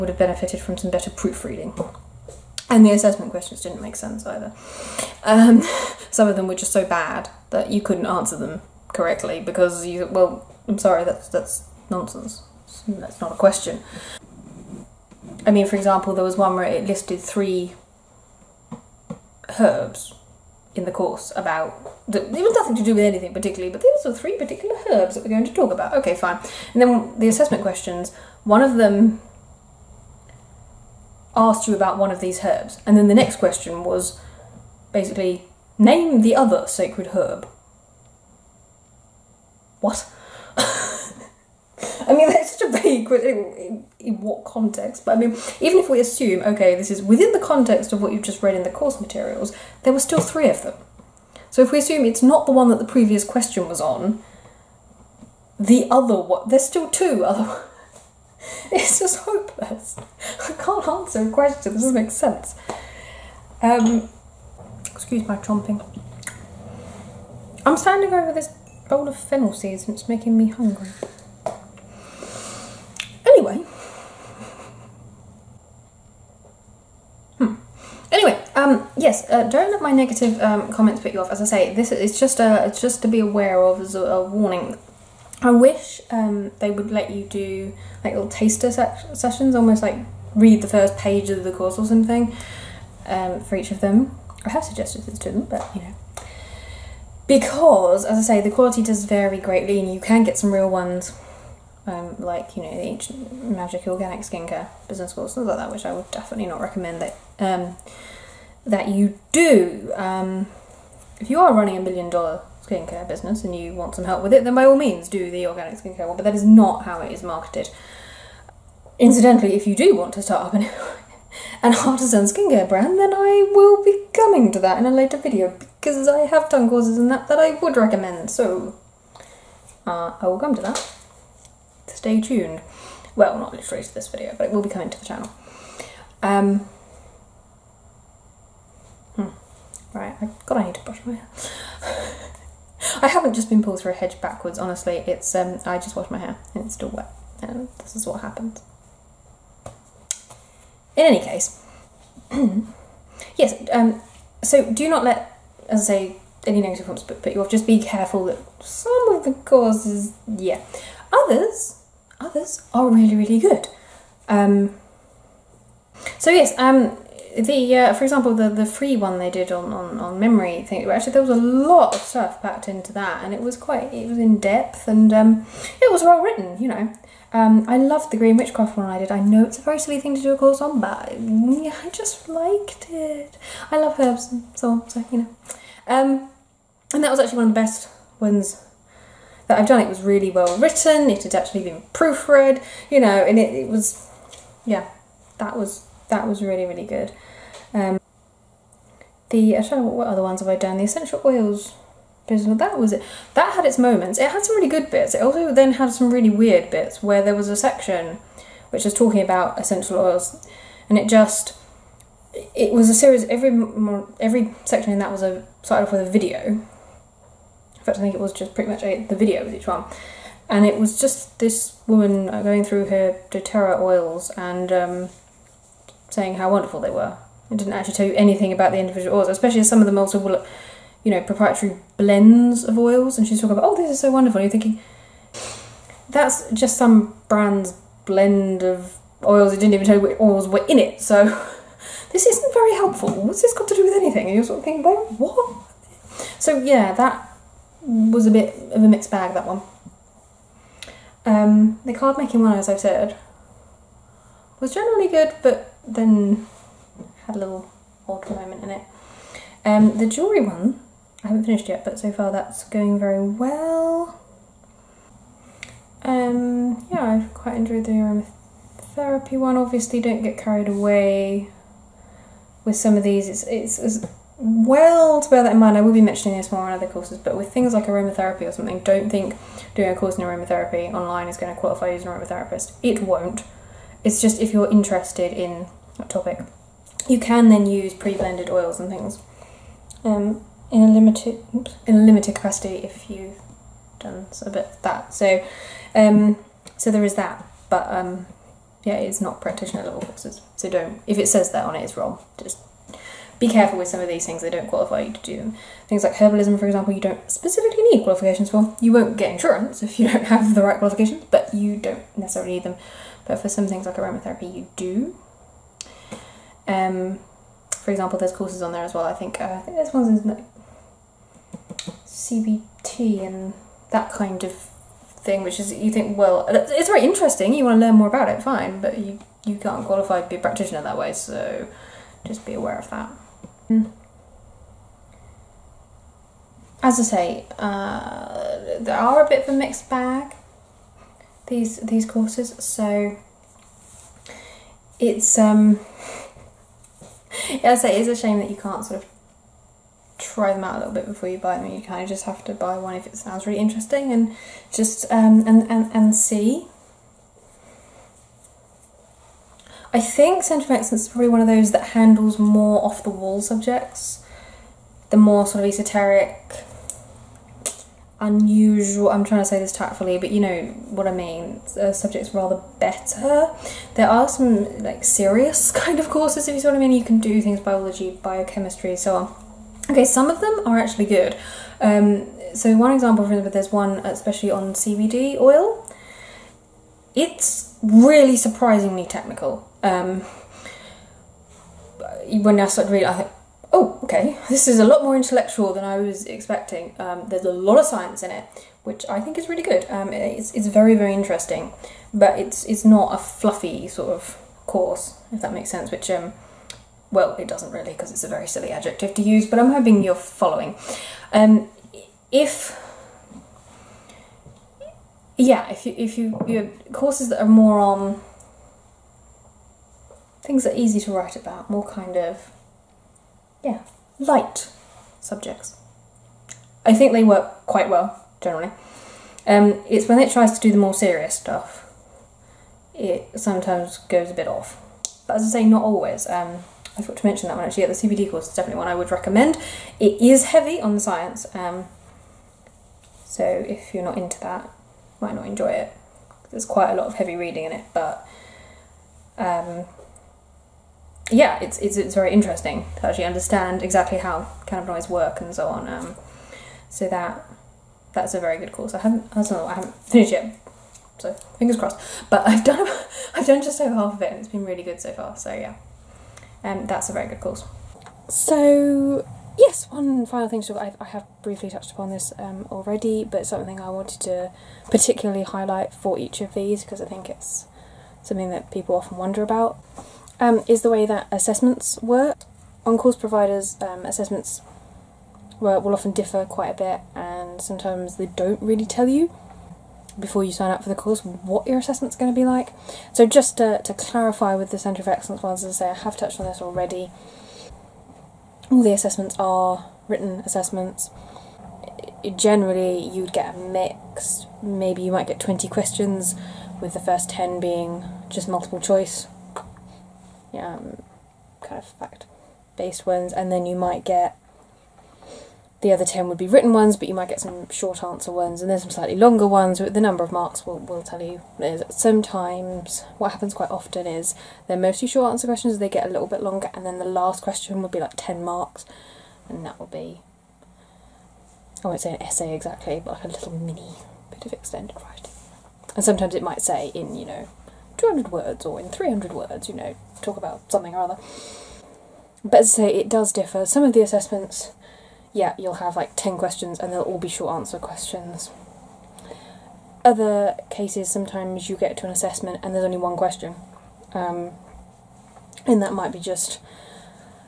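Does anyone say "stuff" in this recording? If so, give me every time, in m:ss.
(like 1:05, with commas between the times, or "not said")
2:52, 7:11.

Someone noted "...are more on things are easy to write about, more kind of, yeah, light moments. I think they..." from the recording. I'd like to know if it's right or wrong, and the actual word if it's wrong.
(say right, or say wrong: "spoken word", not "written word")
wrong: "subjects", not "moments".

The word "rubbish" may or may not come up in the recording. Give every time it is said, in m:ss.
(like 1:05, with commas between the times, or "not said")
not said.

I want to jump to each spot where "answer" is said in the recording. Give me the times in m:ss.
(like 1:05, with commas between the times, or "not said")
0:08, 1:00, 8:38, 8:45, 9:07.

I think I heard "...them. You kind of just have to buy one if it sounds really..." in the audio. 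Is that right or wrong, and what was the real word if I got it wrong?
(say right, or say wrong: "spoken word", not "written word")
right.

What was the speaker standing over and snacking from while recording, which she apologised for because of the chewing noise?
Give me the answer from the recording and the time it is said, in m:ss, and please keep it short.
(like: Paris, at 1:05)
fennel seeds, at 1:09.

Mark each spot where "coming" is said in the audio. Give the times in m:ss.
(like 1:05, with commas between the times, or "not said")
2:04, 2:14.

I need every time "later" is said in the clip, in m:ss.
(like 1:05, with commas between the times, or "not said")
2:04.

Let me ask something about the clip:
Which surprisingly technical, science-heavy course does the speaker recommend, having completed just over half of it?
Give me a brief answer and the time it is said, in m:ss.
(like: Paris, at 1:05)
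CBD oil, at 6:24.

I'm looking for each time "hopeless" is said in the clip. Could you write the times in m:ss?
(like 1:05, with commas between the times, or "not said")
0:59.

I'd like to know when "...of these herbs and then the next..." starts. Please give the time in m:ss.
0:32.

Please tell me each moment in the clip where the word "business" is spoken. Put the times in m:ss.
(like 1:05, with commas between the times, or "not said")
1:44, 1:53, 3:22.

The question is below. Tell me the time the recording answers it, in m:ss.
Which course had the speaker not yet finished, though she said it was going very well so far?
4:20.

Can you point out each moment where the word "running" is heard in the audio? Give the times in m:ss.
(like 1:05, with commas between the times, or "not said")
1:51.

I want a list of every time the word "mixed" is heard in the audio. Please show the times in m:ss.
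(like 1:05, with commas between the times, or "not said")
4:08, 5:39.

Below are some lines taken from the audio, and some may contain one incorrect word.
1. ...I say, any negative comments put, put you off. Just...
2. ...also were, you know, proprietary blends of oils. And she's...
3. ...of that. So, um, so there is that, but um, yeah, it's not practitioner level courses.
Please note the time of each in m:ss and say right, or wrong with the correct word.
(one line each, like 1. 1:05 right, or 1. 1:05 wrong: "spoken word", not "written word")
1. 2:35 right
2. 3:49 right
3. 4:54 right.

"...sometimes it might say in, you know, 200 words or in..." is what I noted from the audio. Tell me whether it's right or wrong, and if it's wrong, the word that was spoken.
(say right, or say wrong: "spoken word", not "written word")
right.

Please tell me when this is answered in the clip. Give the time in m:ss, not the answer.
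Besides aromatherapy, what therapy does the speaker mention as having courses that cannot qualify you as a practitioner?
5:22.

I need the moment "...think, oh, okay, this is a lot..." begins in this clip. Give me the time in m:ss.
6:33.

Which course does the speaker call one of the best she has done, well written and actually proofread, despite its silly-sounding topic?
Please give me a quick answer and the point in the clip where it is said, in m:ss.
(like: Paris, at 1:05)
green witchcraft, at 2:58.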